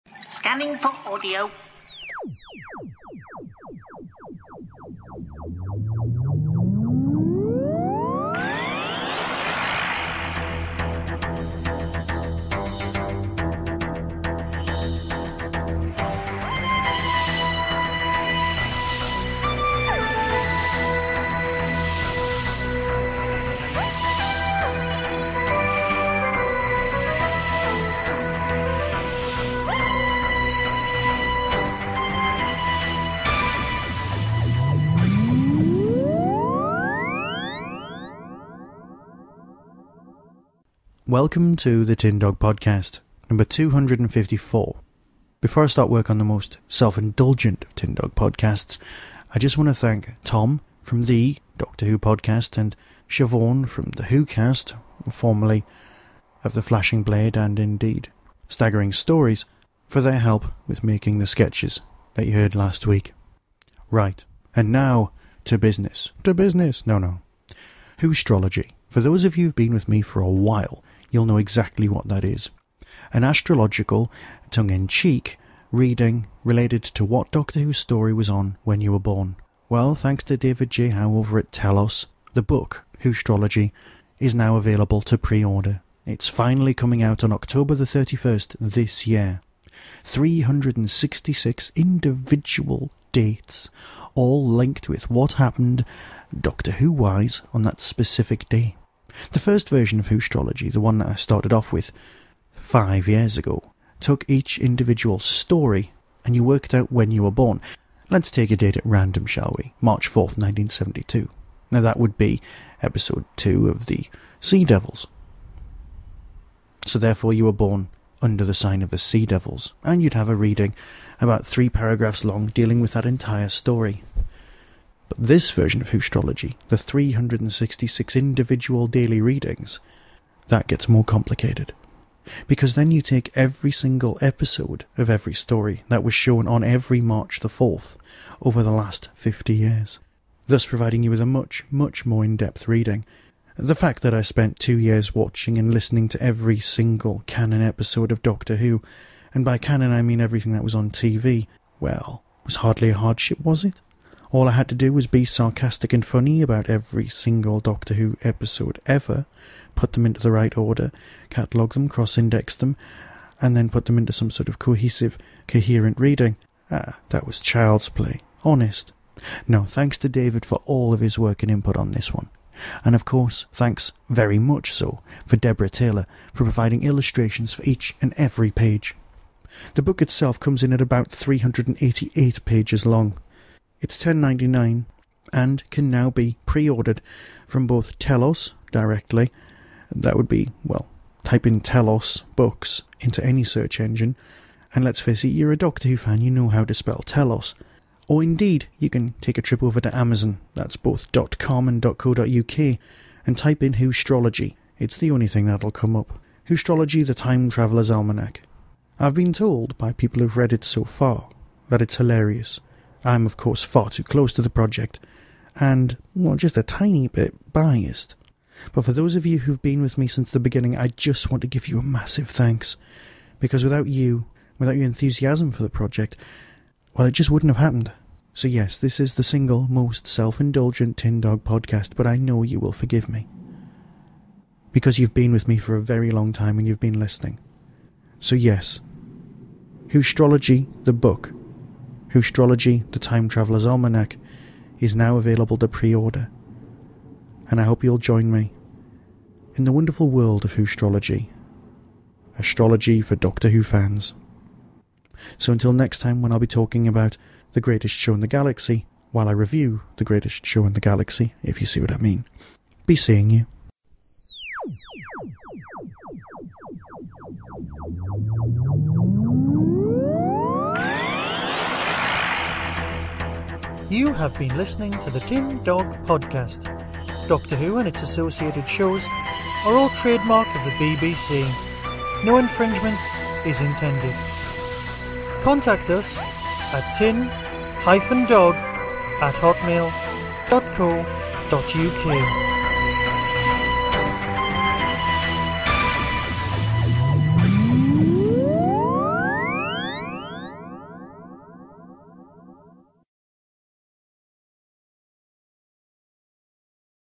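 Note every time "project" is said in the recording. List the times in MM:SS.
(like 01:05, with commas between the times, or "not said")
03:34, 03:45.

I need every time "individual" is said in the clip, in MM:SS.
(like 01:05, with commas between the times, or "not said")
01:31, 01:44, 02:08.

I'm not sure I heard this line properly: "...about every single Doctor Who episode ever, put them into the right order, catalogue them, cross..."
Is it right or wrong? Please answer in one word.
right.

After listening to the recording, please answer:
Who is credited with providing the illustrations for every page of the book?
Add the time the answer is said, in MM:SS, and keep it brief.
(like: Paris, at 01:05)
Deborah Taylor, at 02:55.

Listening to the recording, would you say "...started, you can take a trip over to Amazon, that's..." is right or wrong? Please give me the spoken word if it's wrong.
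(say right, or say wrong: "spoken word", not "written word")
wrong: "indeed", not "started".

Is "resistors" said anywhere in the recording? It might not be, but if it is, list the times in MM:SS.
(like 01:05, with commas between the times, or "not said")
not said.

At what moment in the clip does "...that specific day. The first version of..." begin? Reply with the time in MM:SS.
01:37.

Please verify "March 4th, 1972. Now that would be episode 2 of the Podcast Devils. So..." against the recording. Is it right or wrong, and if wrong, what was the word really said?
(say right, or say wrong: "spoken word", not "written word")
wrong: "Sea", not "Podcast".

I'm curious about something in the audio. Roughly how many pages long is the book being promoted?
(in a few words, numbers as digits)
388.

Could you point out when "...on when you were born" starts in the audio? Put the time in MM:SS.
01:18.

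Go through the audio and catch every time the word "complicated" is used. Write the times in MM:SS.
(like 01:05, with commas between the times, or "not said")
02:11.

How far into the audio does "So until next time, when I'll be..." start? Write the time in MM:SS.
04:15.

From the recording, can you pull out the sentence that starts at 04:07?
And I hope you'll join me in the wonderful world of Whostrology.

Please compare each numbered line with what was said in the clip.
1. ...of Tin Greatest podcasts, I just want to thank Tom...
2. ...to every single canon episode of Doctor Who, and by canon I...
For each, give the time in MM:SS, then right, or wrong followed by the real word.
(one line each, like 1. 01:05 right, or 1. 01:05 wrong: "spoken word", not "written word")
1. 00:47 wrong: "Dog", not "Greatest"
2. 02:26 right.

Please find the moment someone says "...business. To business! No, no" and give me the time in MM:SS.
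01:05.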